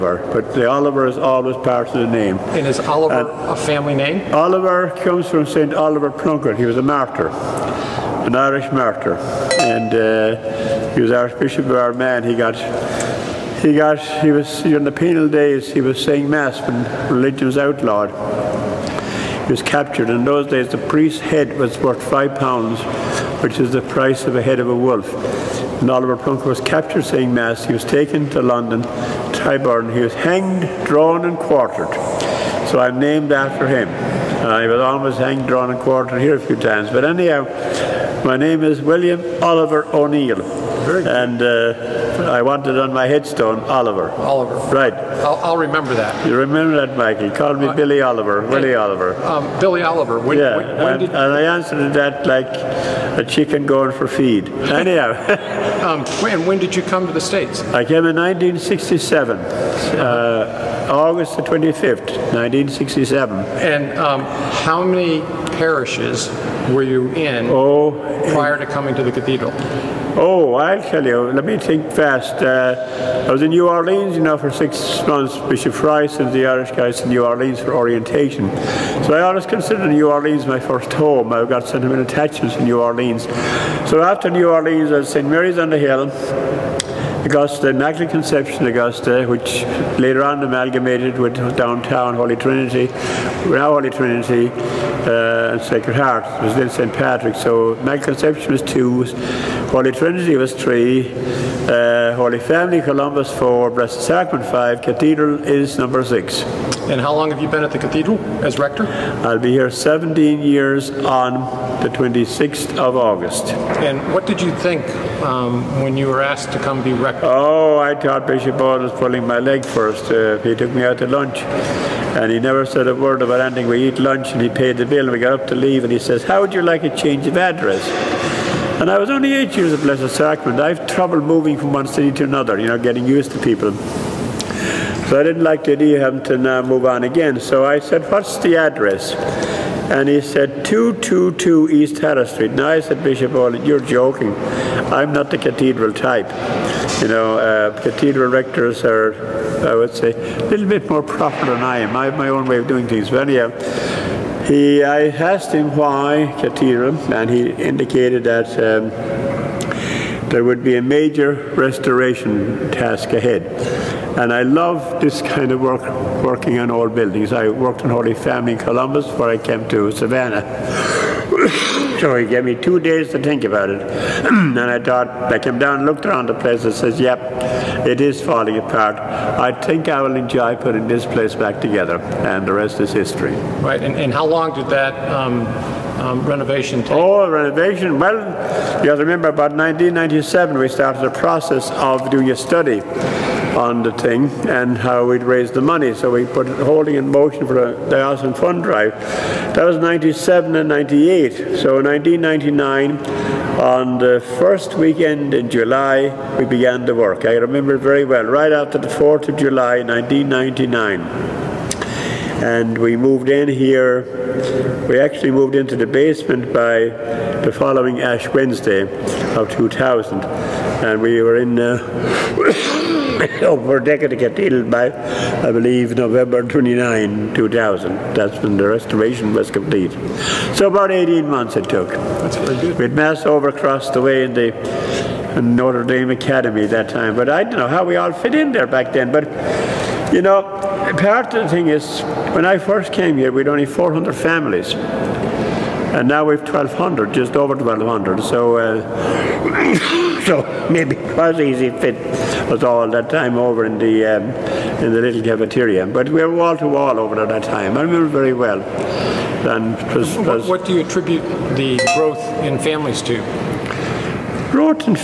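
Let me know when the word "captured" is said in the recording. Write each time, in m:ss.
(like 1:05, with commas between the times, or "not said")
0:19, 0:26.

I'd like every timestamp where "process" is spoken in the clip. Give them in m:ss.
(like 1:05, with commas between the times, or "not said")
3:11.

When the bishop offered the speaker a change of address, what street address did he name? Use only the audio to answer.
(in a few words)
222 East Harris Street.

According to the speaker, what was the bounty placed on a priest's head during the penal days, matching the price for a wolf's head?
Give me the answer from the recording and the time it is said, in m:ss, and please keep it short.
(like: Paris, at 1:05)
5 pounds, at 0:22.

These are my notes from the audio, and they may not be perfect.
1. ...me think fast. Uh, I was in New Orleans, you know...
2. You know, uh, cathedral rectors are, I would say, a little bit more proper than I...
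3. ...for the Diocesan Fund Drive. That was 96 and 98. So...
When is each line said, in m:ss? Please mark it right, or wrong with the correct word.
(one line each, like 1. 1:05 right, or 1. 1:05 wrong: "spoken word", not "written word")
1. 1:11 right
2. 2:27 right
3. 3:17 wrong: "97", not "96".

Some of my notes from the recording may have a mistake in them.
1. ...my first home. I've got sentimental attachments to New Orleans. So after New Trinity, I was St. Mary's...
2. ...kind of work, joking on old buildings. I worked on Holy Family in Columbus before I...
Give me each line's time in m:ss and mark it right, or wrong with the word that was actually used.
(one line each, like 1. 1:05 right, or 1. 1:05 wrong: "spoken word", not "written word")
1. 1:20 wrong: "Orleans", not "Trinity"
2. 2:45 wrong: "working", not "joking".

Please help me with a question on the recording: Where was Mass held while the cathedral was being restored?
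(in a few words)
Notre Dame Academy.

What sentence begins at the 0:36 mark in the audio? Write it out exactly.
But anyhow, my name is William Oliver O'Neill and uh, I wanted on my headstone Oliver.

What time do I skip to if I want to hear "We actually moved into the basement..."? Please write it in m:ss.
3:34.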